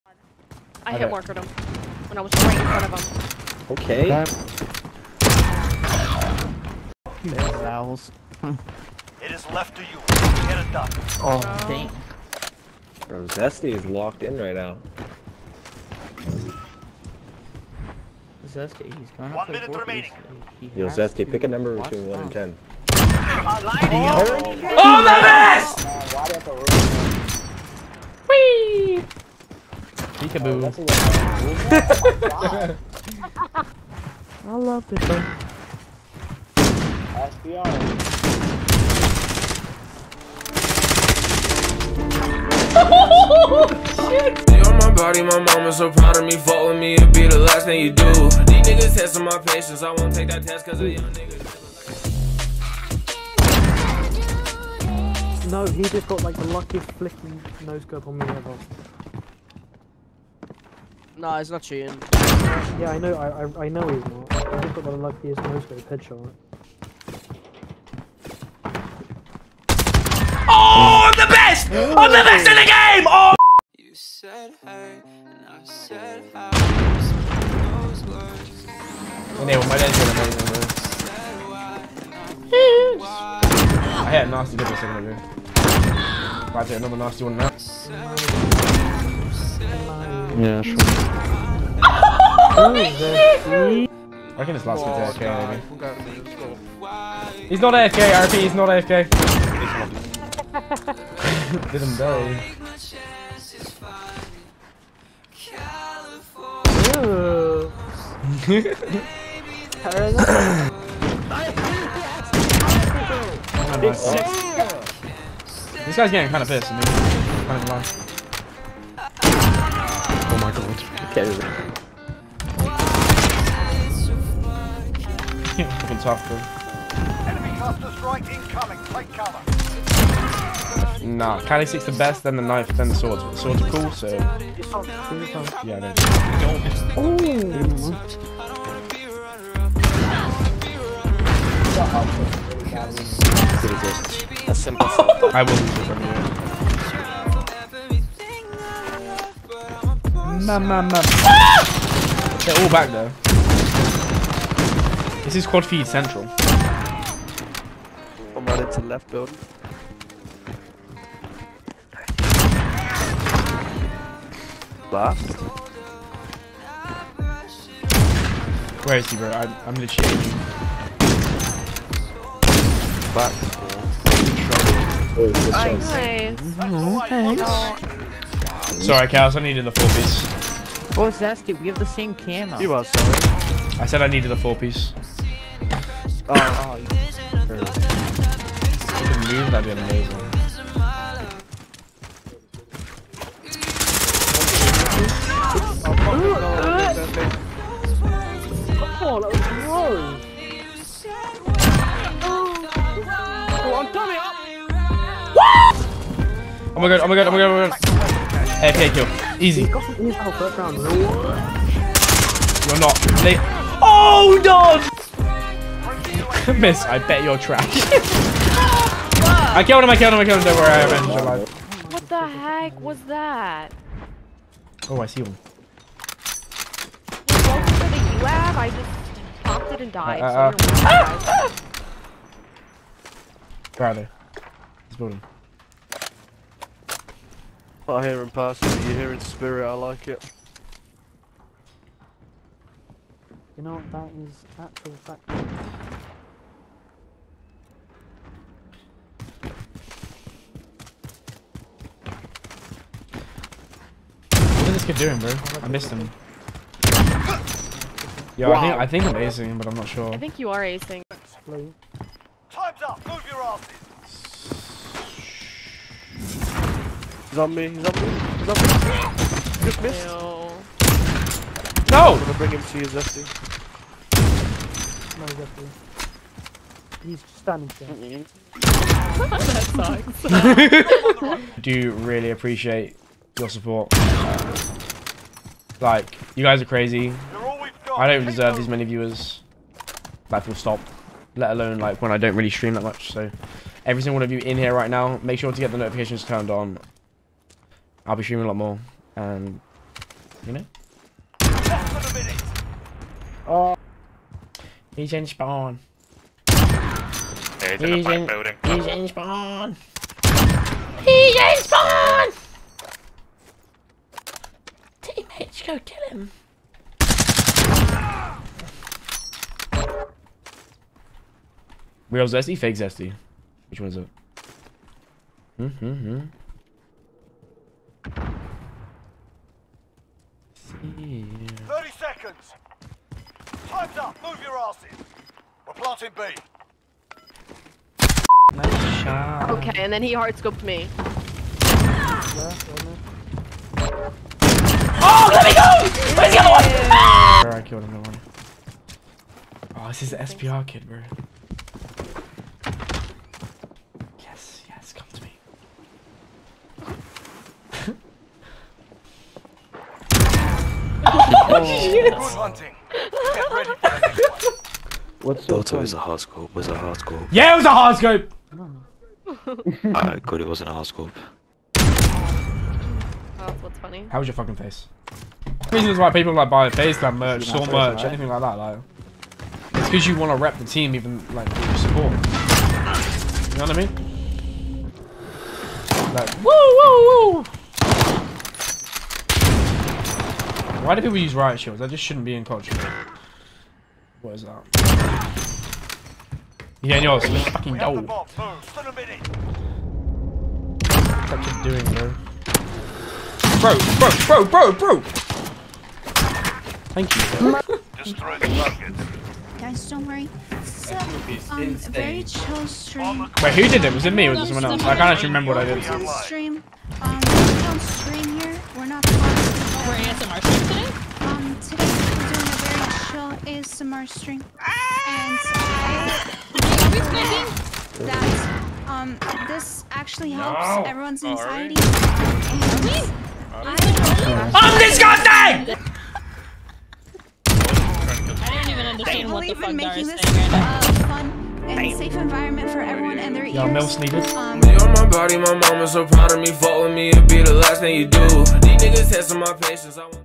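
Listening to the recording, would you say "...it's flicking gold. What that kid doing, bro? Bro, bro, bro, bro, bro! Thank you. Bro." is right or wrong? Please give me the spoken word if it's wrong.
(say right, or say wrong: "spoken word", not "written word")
wrong: "fucking", not "flicking".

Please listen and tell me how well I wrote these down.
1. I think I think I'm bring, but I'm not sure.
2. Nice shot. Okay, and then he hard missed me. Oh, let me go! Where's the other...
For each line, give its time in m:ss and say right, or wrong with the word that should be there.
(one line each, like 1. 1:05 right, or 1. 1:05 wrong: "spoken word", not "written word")
1. 4:18 wrong: "acing", not "bring"
2. 5:38 wrong: "scoped", not "missed".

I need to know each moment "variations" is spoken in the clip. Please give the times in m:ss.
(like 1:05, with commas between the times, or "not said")
not said.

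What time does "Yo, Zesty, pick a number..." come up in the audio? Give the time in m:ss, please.
0:20.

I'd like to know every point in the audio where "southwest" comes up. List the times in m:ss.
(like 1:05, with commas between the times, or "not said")
not said.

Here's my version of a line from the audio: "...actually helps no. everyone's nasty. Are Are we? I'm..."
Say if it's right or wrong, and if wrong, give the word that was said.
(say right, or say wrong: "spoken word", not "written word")
wrong: "anxiety", not "nasty".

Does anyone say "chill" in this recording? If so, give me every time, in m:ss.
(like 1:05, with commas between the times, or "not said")
6:52, 7:03.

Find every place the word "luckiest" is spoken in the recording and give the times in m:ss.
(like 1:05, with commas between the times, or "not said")
0:56, 1:04.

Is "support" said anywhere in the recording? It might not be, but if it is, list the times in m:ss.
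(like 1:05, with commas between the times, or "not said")
4:43, 6:21.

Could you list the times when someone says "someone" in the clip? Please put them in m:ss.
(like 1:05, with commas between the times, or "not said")
6:54.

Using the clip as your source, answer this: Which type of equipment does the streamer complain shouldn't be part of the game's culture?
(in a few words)
Riot shields.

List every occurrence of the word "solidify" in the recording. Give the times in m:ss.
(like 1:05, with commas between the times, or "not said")
not said.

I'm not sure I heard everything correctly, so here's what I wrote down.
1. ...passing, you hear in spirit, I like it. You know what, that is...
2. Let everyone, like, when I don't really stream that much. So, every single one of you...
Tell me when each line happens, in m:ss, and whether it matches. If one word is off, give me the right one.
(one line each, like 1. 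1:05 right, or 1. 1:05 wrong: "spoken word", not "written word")
1. 3:58 right
2. 4:51 wrong: "alone", not "everyone".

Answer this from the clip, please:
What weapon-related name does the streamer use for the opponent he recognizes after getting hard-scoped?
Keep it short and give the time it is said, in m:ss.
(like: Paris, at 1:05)
SPR kid, at 5:50.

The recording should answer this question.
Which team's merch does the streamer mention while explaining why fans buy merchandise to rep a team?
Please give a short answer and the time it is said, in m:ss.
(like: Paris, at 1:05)
Basecamp, at 6:16.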